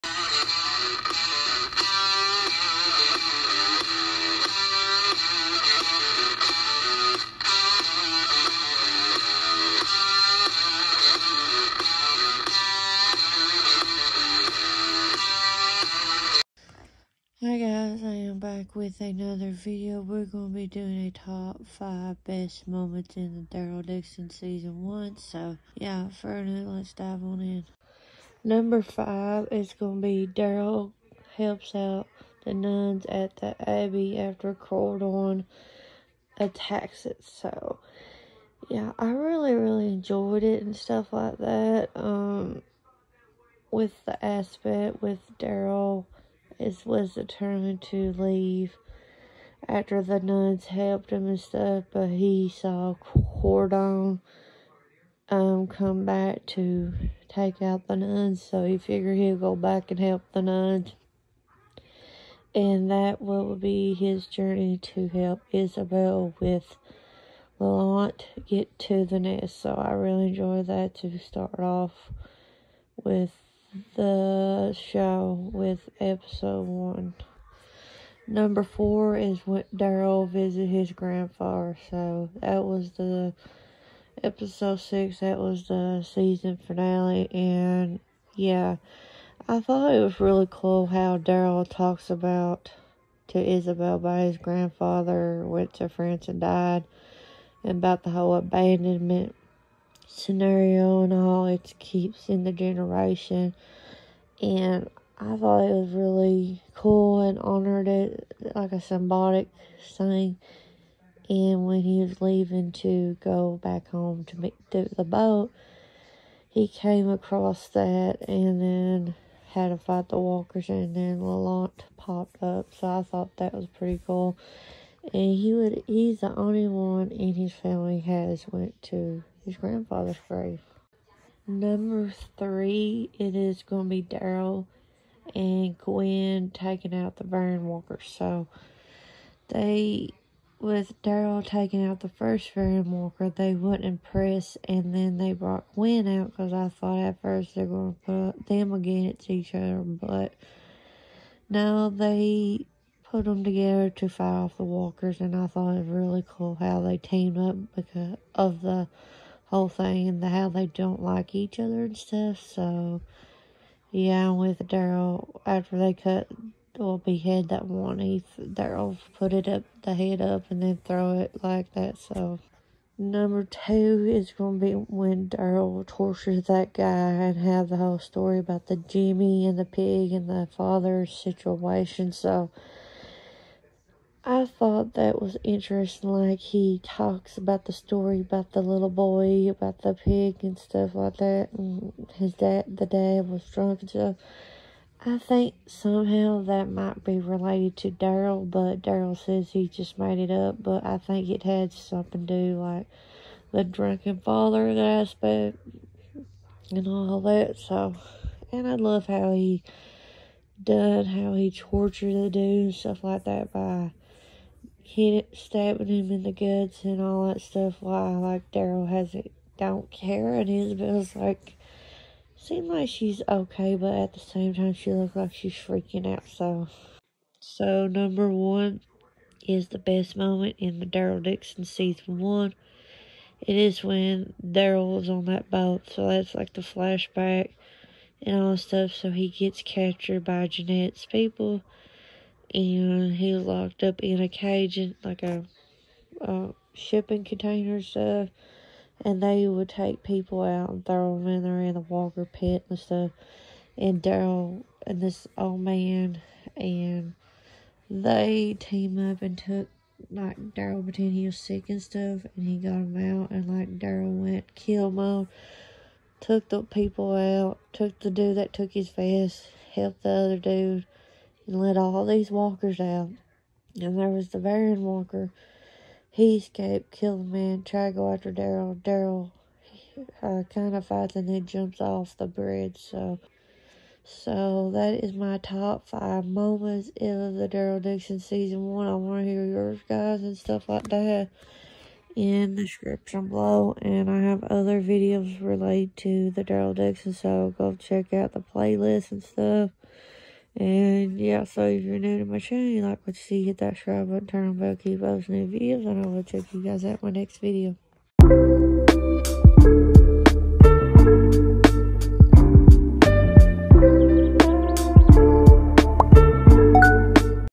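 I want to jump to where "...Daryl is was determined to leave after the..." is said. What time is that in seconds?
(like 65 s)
45 s.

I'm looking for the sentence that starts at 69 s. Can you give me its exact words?
So I really enjoy that to start off with the show with episode one.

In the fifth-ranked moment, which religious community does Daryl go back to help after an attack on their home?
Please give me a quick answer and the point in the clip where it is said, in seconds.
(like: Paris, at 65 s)
The nuns at the Abbey, at 32 s.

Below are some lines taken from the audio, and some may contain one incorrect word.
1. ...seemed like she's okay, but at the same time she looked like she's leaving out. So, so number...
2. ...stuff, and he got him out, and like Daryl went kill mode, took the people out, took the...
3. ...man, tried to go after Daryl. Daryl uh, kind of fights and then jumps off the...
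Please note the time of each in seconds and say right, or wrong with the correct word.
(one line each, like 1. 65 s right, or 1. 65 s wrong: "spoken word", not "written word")
1. 222 s wrong: "freaking", not "leaving"
2. 261 s right
3. 277 s right.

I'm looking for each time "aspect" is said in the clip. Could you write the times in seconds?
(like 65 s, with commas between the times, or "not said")
44 s, 204 s.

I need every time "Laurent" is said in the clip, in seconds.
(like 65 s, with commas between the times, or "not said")
67 s, 121 s.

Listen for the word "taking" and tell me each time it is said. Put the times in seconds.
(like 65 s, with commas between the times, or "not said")
136 s, 141 s.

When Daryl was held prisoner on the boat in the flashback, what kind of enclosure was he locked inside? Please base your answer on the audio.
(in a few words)
A shipping container.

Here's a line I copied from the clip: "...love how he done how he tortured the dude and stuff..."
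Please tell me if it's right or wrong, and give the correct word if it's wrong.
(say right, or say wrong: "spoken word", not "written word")
right.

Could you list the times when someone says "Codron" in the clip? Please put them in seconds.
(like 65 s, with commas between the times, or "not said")
34 s, 53 s.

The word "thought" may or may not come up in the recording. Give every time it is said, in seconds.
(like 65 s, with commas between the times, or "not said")
89 s, 105 s, 123 s, 146 s, 155 s, 184 s.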